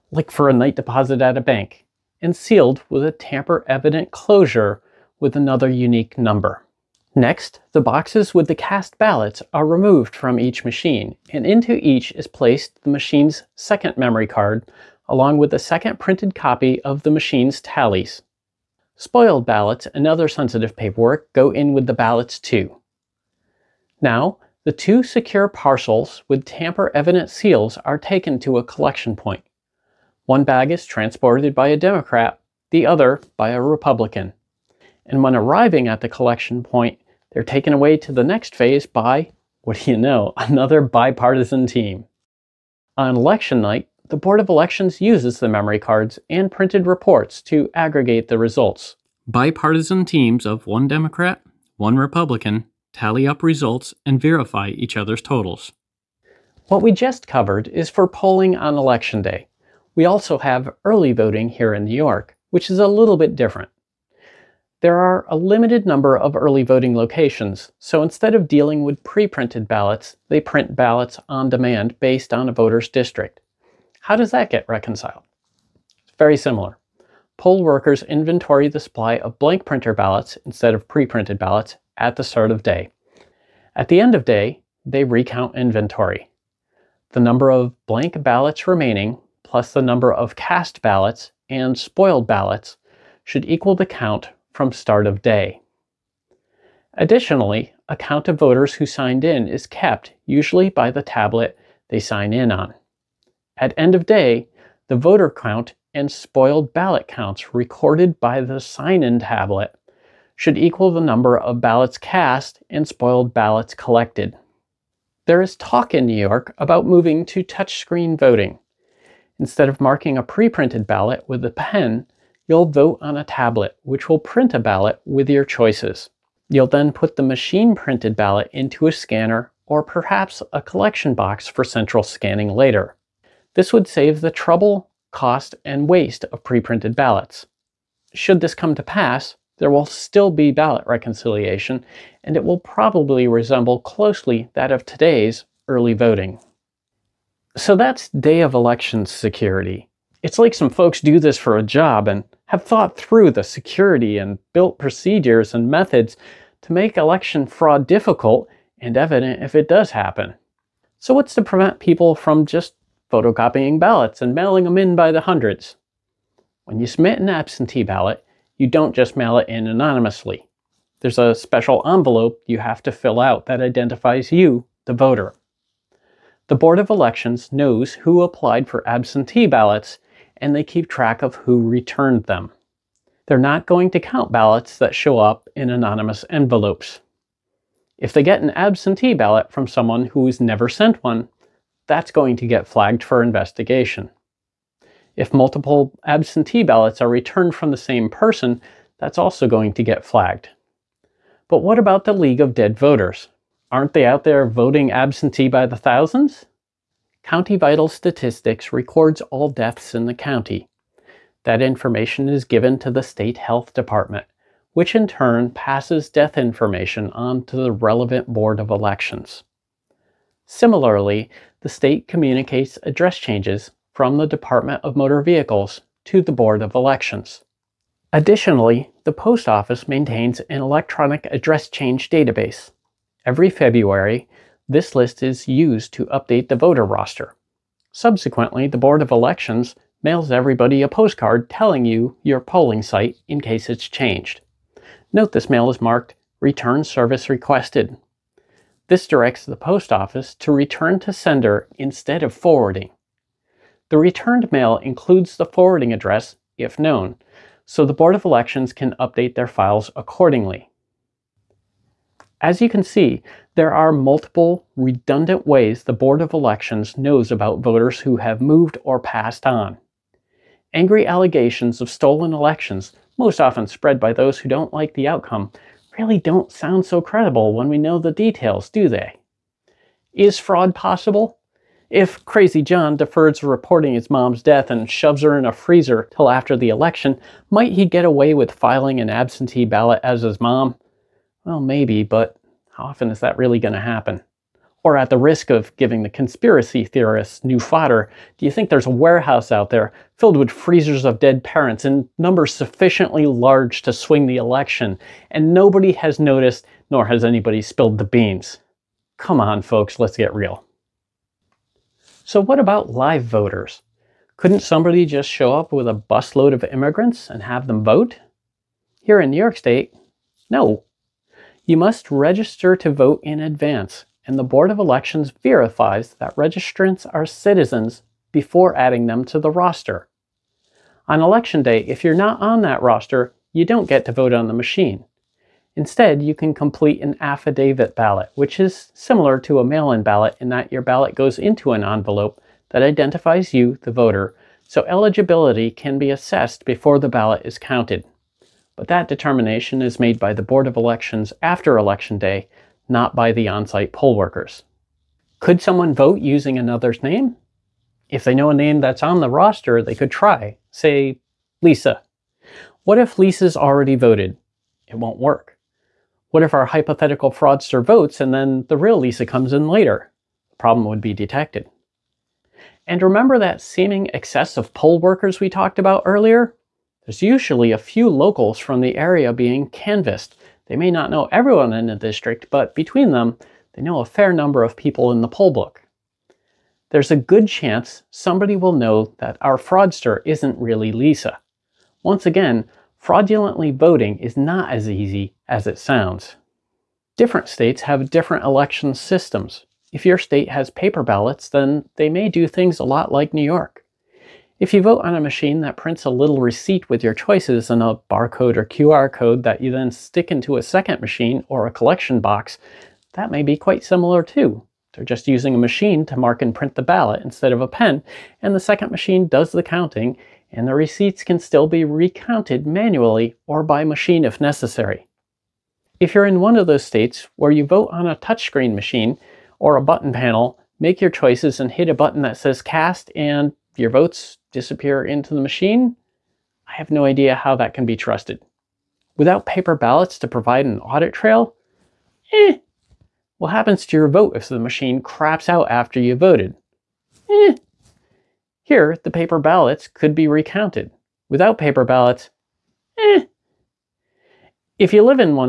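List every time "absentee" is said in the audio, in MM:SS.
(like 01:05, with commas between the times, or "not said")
02:47, 02:58, 03:08, 03:16, 03:24, 04:49.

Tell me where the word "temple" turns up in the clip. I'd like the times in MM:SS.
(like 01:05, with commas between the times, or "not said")
not said.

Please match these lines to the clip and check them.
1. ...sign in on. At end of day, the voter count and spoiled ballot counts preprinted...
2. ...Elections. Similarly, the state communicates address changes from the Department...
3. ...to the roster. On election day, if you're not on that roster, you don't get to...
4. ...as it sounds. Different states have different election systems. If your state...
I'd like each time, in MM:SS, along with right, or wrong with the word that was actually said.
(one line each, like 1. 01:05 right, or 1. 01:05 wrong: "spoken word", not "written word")
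1. 01:41 wrong: "recorded", not "preprinted"
2. 03:38 right
3. 05:29 right
4. 06:35 right.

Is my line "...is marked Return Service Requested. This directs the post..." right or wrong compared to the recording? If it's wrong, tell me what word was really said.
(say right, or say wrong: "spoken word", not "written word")
right.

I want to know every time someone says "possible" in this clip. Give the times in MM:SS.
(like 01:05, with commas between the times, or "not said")
04:40.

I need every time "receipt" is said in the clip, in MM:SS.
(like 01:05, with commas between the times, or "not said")
06:46, 07:00.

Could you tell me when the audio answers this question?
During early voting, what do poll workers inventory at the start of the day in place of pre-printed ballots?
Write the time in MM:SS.
01:19.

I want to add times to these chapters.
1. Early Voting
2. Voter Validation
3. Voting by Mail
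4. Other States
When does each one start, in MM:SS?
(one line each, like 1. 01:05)
1. 00:55
2. 05:10
3. 02:26
4. 06:36.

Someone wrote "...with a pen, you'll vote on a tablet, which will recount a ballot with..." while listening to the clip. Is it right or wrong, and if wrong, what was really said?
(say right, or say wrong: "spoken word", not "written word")
wrong: "print", not "recount".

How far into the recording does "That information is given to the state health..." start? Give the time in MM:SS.
03:31.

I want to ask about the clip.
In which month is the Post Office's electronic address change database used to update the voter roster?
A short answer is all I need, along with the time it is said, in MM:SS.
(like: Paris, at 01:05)
February, at 03:53.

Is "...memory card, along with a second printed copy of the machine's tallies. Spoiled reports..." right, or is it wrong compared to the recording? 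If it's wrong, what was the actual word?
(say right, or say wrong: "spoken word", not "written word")
wrong: "ballots", not "reports".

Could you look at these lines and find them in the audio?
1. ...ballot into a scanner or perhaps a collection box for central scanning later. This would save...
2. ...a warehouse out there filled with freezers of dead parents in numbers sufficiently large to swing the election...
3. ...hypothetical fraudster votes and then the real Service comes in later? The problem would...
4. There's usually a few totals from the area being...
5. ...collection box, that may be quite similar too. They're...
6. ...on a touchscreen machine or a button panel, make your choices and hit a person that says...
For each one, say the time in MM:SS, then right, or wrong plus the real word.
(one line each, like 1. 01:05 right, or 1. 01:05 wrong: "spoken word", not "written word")
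1. 02:08 right
2. 04:58 right
3. 06:06 wrong: "Lisa", not "Service"
4. 06:17 wrong: "locals", not "totals"
5. 06:51 right
6. 07:07 wrong: "button", not "person".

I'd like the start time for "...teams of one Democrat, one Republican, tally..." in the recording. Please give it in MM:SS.
00:50.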